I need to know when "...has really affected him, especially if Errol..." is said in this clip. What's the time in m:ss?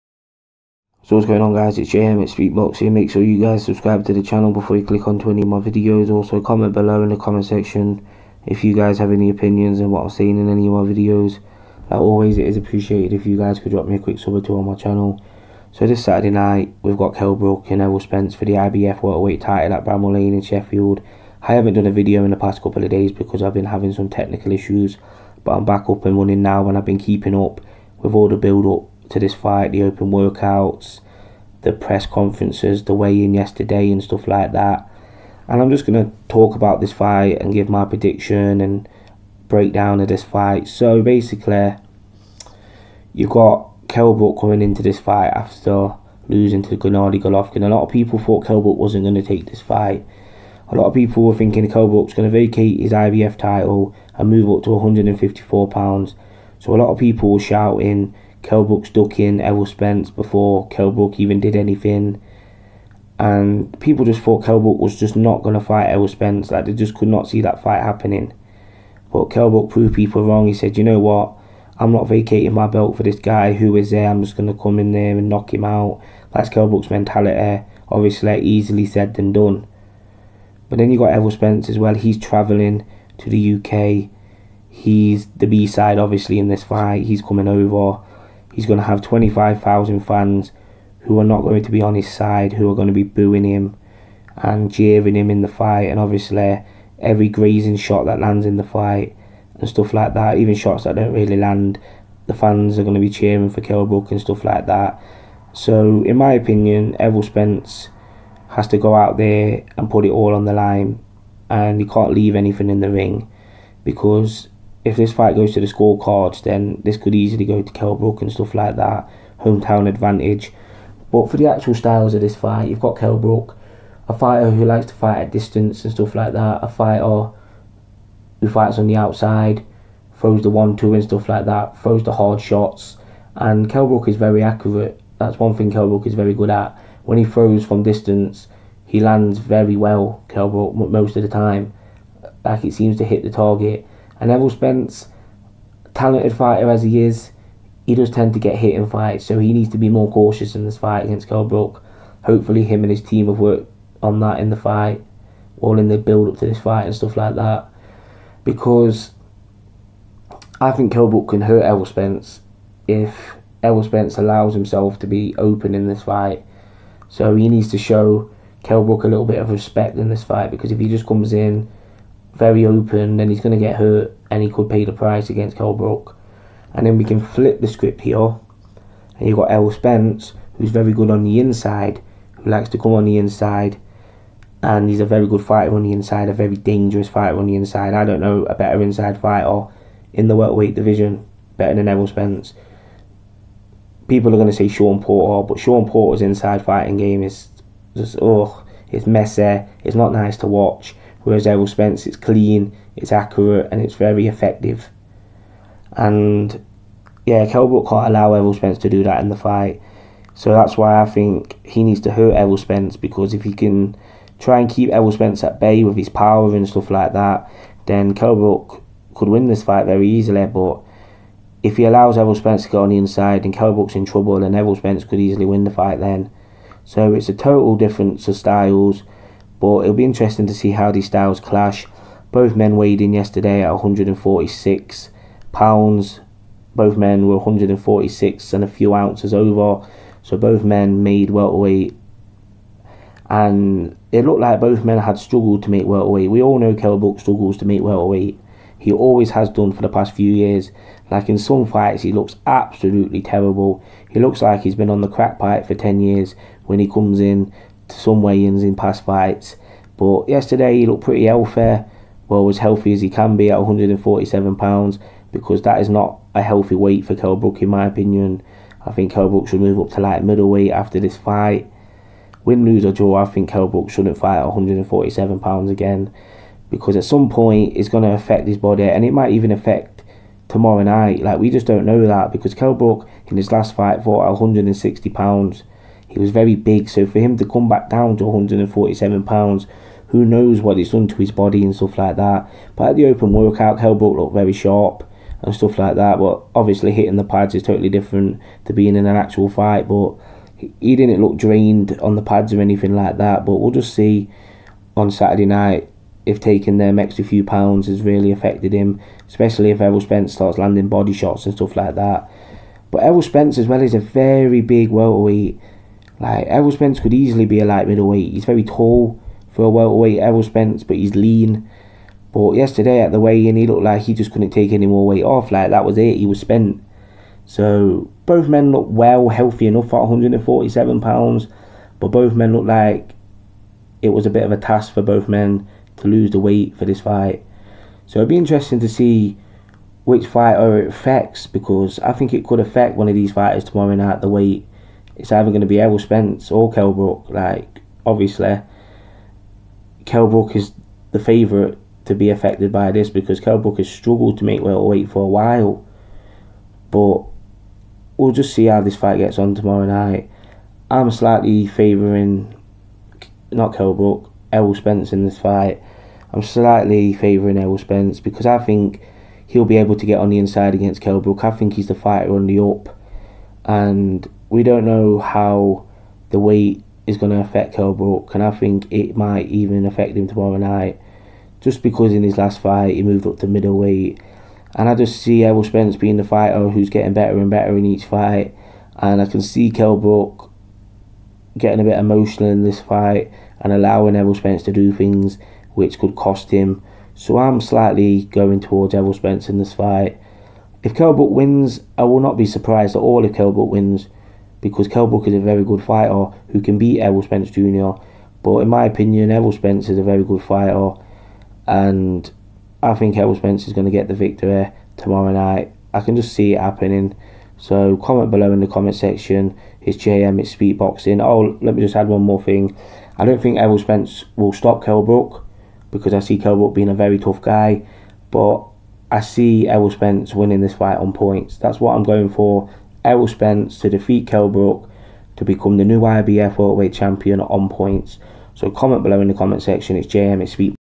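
5:07.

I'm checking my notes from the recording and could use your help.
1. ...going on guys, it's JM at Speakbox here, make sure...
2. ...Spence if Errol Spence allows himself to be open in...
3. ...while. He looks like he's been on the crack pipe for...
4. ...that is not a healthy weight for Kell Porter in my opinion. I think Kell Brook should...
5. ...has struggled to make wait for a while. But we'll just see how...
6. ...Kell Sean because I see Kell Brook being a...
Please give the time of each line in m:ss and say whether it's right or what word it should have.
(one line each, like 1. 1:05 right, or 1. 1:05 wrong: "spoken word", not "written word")
1. 0:01 right
2. 2:41 right
3. 4:13 wrong: "terrible", not "while"
4. 4:25 wrong: "Brook", not "Porter"
5. 5:53 right
6. 7:04 wrong: "Brook", not "Sean".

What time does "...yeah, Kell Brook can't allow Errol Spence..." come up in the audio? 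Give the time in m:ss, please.
3:27.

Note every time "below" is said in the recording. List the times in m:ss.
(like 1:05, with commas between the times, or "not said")
0:06, 6:58, 7:19.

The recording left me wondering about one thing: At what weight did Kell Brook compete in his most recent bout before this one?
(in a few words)
160 pounds.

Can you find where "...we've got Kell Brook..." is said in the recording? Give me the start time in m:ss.
0:16.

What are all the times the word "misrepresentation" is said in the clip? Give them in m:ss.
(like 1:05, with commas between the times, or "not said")
not said.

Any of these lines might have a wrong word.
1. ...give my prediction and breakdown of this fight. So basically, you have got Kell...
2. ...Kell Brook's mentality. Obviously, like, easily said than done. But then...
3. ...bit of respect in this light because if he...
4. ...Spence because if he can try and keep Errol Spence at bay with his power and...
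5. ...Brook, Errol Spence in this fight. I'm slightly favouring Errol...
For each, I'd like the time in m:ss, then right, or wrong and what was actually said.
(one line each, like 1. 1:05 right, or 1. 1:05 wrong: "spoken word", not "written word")
1. 0:37 right
2. 1:16 right
3. 2:49 wrong: "fight", not "light"
4. 3:32 right
5. 6:03 right.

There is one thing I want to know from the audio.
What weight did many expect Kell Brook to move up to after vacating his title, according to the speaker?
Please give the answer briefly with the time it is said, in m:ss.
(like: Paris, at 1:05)
154 pounds, at 0:54.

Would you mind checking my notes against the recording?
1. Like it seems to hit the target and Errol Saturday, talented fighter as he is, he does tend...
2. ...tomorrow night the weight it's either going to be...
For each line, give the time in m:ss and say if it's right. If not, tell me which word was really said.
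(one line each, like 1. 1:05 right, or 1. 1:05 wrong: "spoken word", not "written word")
1. 2:22 wrong: "Spence", not "Saturday"
2. 5:43 right.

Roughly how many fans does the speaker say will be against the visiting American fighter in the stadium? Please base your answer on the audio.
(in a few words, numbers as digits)
25,000.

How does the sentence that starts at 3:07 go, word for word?
I don't know a better inside fighter in the welterweight division, better than Errol Spence.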